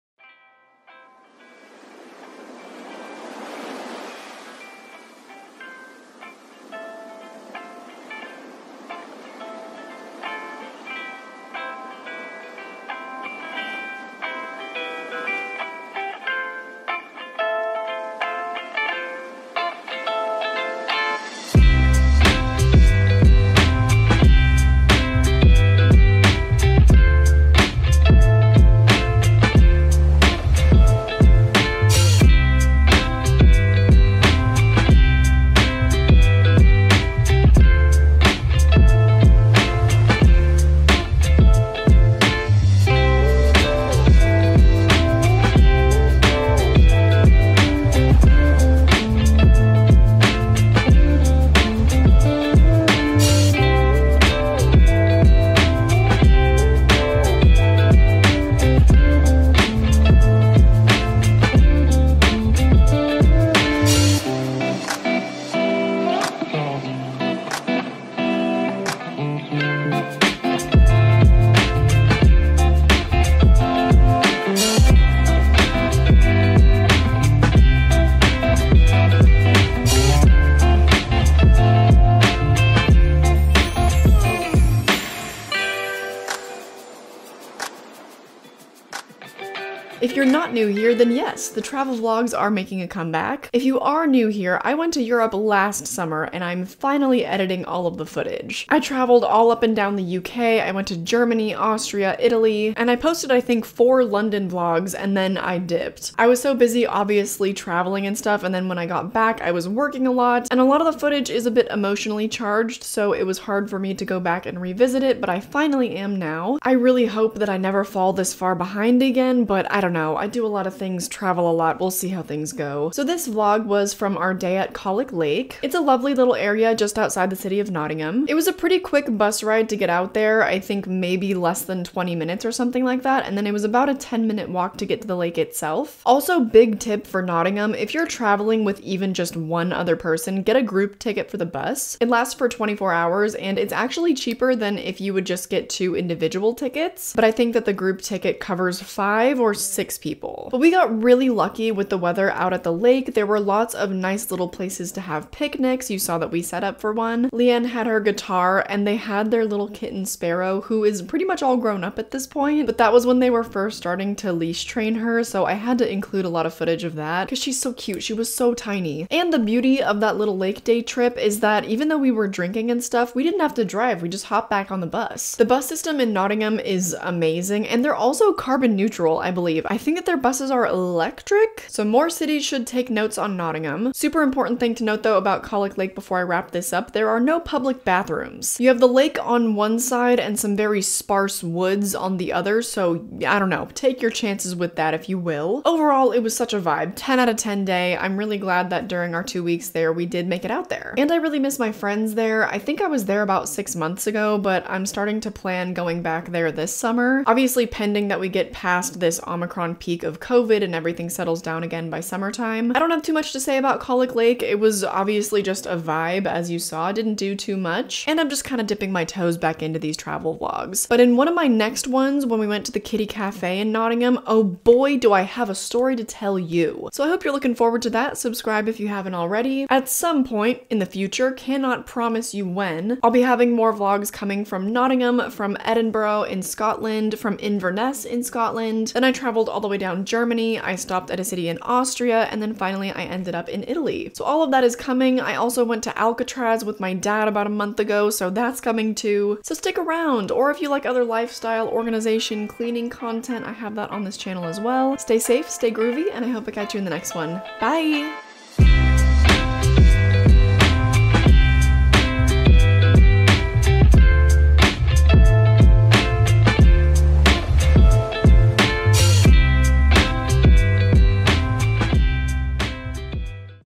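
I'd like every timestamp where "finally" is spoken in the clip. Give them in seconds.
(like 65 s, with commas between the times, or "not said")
96 s, 115 s, 242 s.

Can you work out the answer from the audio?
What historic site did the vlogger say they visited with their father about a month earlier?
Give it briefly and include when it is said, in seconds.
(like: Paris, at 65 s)
Alcatraz, at 245 s.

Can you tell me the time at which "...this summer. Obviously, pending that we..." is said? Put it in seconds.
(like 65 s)
206 s.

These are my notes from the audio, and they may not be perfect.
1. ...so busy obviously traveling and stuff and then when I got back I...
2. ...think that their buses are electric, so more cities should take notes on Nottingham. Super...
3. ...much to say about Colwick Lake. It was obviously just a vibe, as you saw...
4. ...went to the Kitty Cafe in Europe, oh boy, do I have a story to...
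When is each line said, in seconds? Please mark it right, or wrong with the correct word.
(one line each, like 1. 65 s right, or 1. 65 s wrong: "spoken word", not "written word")
1. 106 s right
2. 179 s right
3. 213 s right
4. 222 s wrong: "Nottingham", not "Europe".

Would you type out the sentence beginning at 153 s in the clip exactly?
There were lots of nice little places to have picnics.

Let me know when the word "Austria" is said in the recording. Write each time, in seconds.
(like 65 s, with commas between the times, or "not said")
101 s, 241 s.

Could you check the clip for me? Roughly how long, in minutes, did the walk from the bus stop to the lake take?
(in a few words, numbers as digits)
10 minutes.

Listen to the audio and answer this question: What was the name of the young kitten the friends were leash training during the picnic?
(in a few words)
Sparrow.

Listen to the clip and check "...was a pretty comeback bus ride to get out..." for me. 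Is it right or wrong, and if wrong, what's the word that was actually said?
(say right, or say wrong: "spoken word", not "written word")
wrong: "quick", not "comeback".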